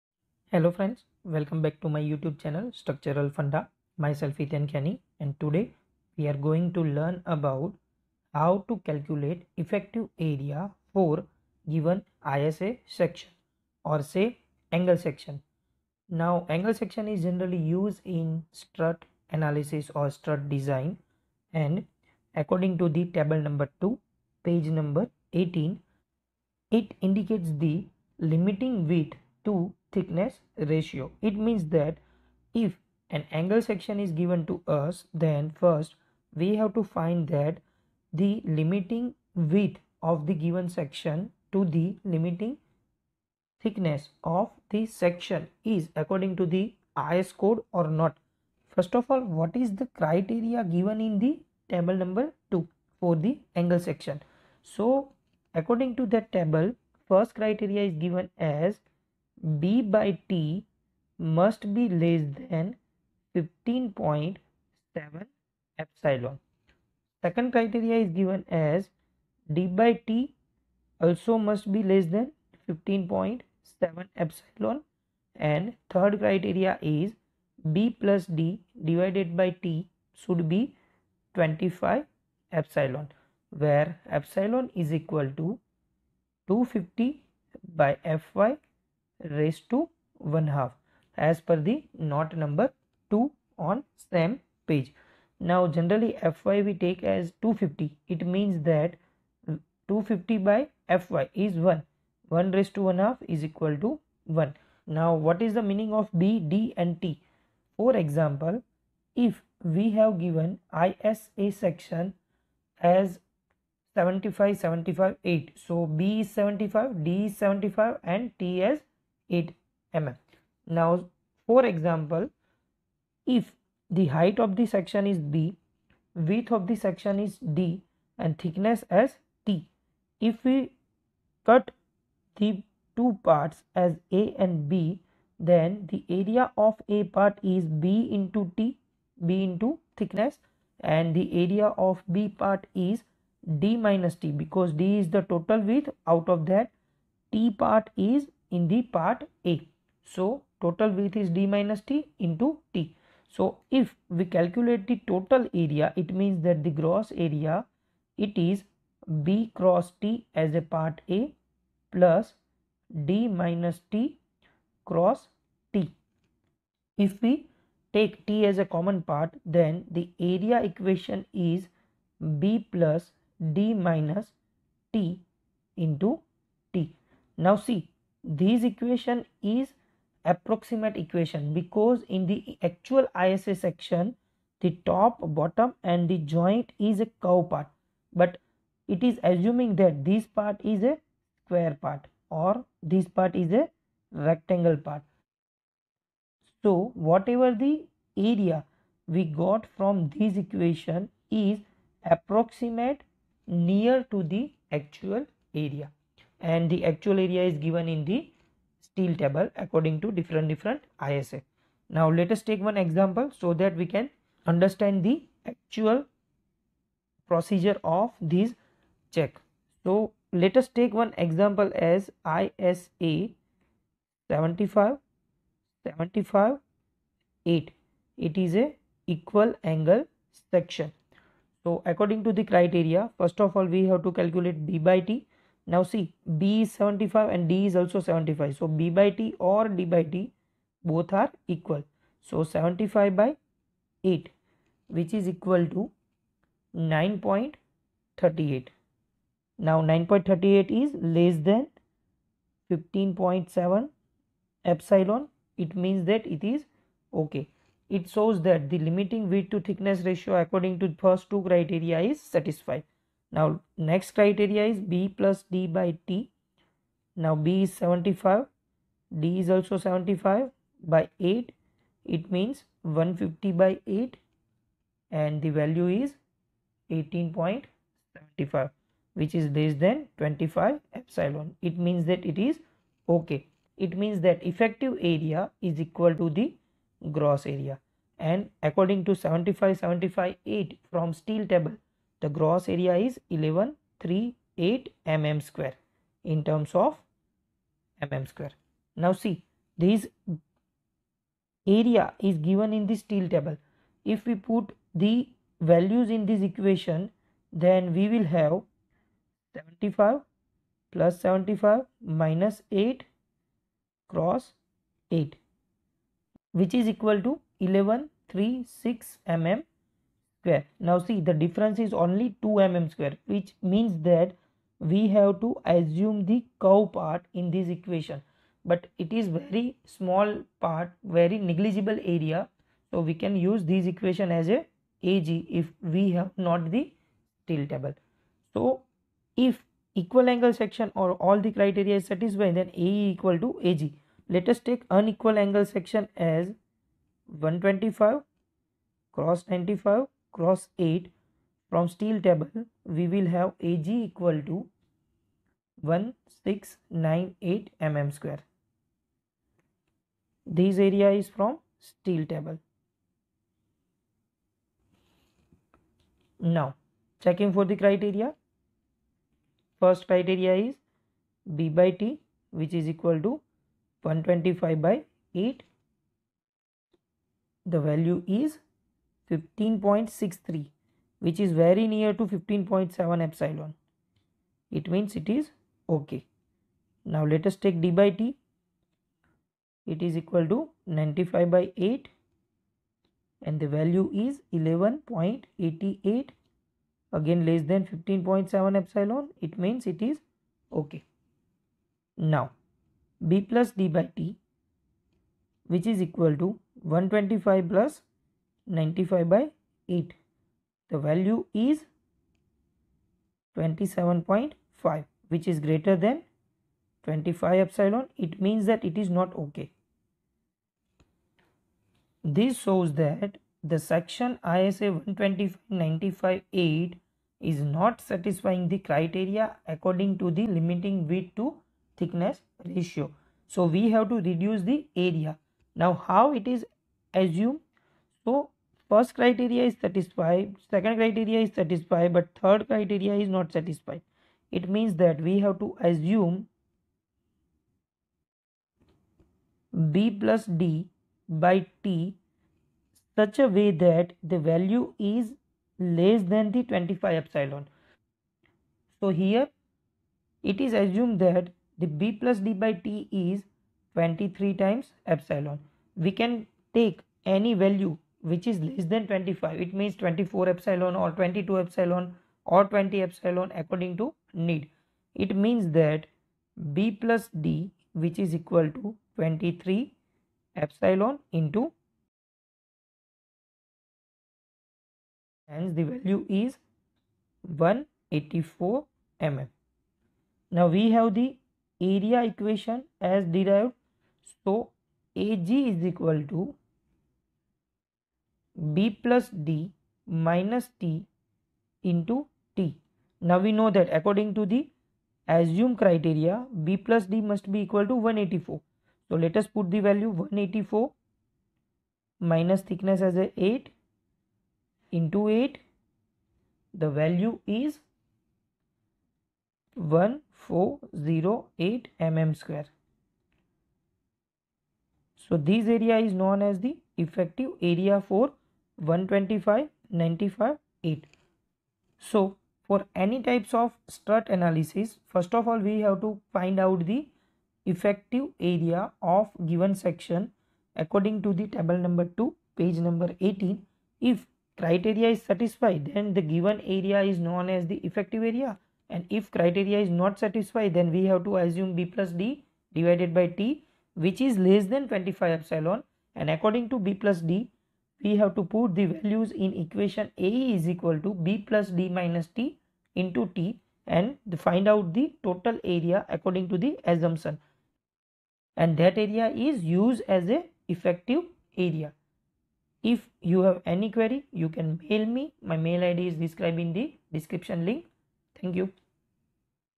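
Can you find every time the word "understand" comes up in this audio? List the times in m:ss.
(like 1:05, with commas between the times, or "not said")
3:34.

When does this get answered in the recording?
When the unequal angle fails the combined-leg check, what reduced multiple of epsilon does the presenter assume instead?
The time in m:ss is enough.
7:43.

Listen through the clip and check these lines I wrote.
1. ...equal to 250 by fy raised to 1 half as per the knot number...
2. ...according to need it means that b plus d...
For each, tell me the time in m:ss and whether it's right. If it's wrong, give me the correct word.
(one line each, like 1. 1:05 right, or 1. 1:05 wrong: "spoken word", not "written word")
1. 1:24 right
2. 7:53 right.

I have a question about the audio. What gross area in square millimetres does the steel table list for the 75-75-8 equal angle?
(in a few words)
1138 mm².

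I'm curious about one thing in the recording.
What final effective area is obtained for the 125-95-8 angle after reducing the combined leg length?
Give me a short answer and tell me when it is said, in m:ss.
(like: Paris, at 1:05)
1408 mm², at 8:39.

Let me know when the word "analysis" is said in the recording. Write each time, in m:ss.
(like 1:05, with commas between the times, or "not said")
0:19, 8:54.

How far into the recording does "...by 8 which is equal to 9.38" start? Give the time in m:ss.
4:03.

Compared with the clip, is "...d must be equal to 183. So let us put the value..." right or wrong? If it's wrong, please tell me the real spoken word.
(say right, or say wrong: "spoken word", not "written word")
wrong: "184", not "183".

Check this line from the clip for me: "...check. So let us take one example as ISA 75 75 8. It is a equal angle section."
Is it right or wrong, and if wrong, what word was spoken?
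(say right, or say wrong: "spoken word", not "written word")
right.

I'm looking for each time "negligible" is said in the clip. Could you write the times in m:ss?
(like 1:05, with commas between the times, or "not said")
5:31.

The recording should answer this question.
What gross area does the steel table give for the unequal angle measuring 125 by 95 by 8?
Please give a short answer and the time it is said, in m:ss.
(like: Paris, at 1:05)
1698 mm², at 5:55.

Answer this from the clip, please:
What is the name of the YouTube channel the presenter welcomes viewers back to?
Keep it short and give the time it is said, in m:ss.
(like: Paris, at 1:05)
Structural Funda, at 0:02.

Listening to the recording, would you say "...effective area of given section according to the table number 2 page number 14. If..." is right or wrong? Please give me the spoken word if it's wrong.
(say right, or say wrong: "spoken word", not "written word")
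wrong: "18", not "14".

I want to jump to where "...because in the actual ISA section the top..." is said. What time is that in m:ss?
3:01.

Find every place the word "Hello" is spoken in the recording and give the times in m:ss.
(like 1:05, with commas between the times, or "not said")
0:00.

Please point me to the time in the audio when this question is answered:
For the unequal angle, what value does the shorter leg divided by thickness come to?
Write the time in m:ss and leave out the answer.
6:34.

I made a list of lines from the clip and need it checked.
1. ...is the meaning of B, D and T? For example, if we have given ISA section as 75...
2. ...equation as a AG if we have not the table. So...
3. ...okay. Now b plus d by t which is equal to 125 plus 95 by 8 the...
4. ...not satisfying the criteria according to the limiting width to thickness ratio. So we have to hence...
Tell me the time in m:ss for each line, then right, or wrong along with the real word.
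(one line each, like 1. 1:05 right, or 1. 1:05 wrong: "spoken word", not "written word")
1. 1:45 right
2. 5:33 right
3. 6:40 right
4. 7:07 wrong: "reduce", not "hence".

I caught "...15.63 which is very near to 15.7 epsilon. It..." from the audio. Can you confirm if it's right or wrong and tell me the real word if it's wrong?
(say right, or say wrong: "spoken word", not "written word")
right.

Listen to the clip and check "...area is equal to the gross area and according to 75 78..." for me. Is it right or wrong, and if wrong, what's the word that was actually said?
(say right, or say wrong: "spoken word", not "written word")
wrong: "75", not "78".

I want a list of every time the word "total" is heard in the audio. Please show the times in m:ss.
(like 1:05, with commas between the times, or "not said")
2:25, 2:30, 2:35, 9:25.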